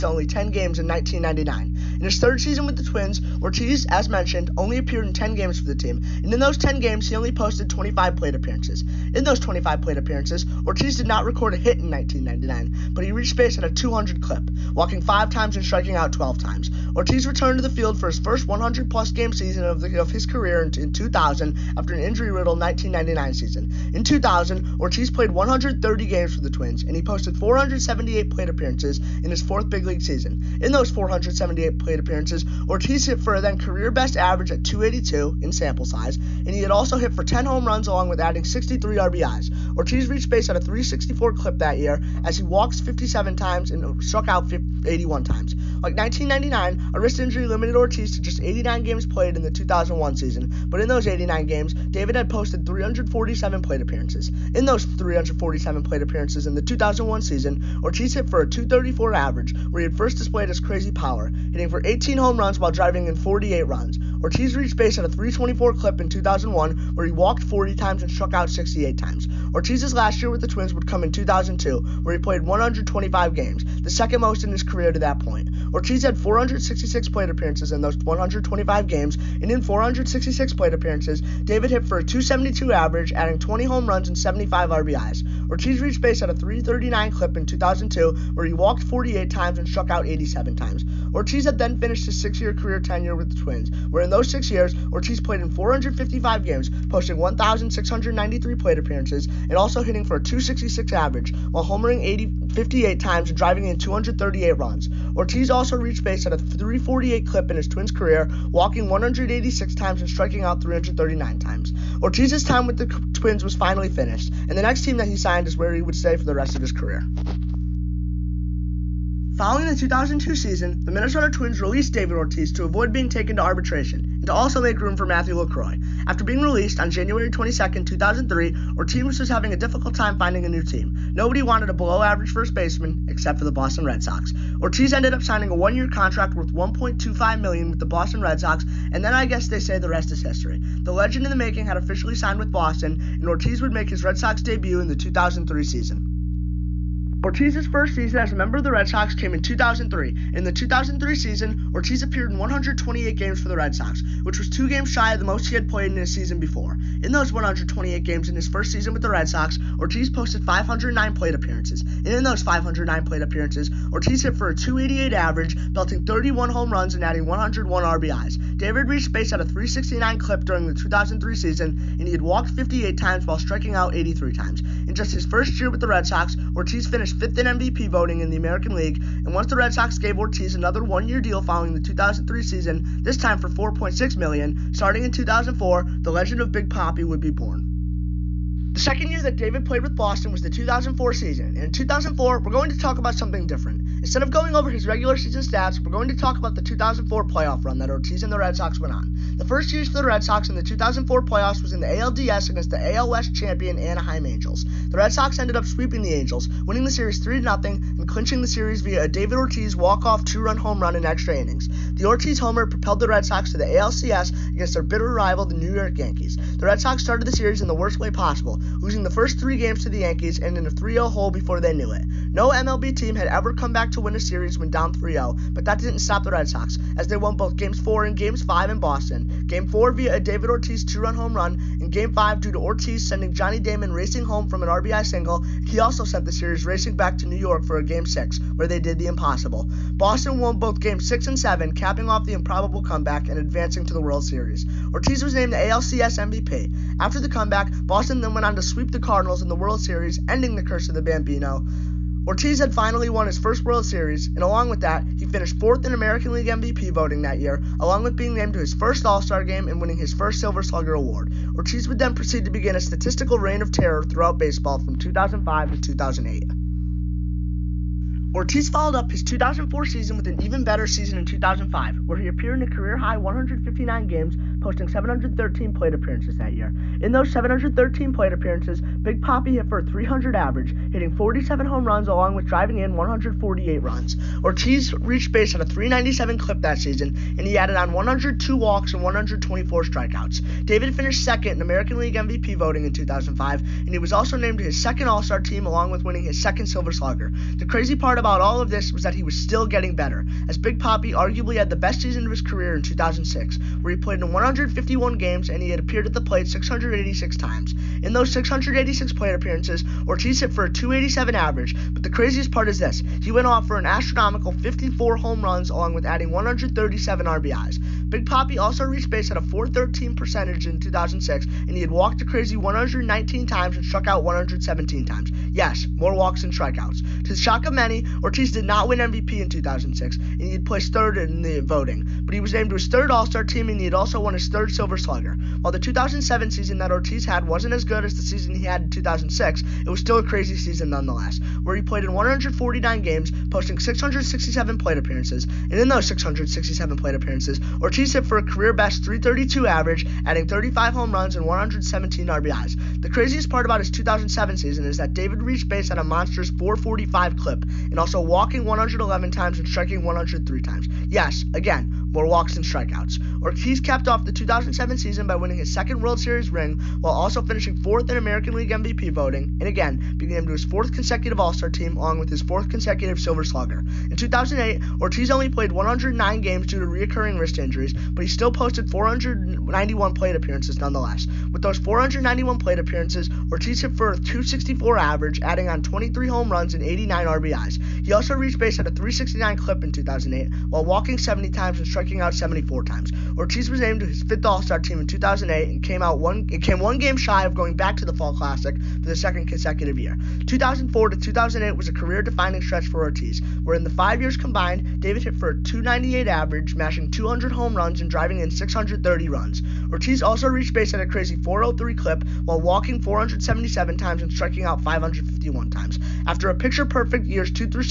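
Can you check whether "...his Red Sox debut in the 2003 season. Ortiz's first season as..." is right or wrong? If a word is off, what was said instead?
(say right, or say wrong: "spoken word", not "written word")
right.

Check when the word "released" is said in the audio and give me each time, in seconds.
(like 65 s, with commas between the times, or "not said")
121 s, 126 s.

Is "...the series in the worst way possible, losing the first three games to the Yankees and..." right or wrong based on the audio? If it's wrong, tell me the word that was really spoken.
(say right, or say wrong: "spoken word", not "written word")
right.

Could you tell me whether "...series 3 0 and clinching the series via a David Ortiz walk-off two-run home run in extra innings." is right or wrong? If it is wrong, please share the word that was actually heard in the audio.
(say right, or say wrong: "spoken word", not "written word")
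right.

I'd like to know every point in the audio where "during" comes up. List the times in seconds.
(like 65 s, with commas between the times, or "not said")
170 s.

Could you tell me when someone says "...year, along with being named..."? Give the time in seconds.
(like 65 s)
257 s.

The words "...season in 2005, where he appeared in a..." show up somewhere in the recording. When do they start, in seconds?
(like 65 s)
270 s.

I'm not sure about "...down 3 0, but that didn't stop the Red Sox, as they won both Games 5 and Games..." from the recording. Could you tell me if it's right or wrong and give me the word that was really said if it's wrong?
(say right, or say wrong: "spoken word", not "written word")
wrong: "4", not "5".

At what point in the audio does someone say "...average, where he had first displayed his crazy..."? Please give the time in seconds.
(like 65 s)
59 s.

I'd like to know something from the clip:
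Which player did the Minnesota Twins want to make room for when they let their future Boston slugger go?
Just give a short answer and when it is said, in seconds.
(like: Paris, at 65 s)
Matthew LeCroy, at 125 s.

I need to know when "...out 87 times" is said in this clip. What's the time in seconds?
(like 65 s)
89 s.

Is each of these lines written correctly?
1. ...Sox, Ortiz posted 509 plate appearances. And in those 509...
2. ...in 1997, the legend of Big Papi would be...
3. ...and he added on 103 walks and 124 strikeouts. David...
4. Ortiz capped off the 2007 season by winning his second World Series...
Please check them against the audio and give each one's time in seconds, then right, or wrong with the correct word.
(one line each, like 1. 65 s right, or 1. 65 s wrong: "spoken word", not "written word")
1. 159 s right
2. 185 s wrong: "2004", not "1997"
3. 287 s wrong: "102", not "103"
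4. 363 s right.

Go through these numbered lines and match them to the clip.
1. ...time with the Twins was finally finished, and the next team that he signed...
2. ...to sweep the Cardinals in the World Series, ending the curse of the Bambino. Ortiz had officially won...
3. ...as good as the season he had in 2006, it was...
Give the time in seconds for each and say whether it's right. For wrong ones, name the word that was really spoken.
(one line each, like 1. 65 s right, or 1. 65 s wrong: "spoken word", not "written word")
1. 112 s right
2. 248 s wrong: "finally", not "officially"
3. 337 s right.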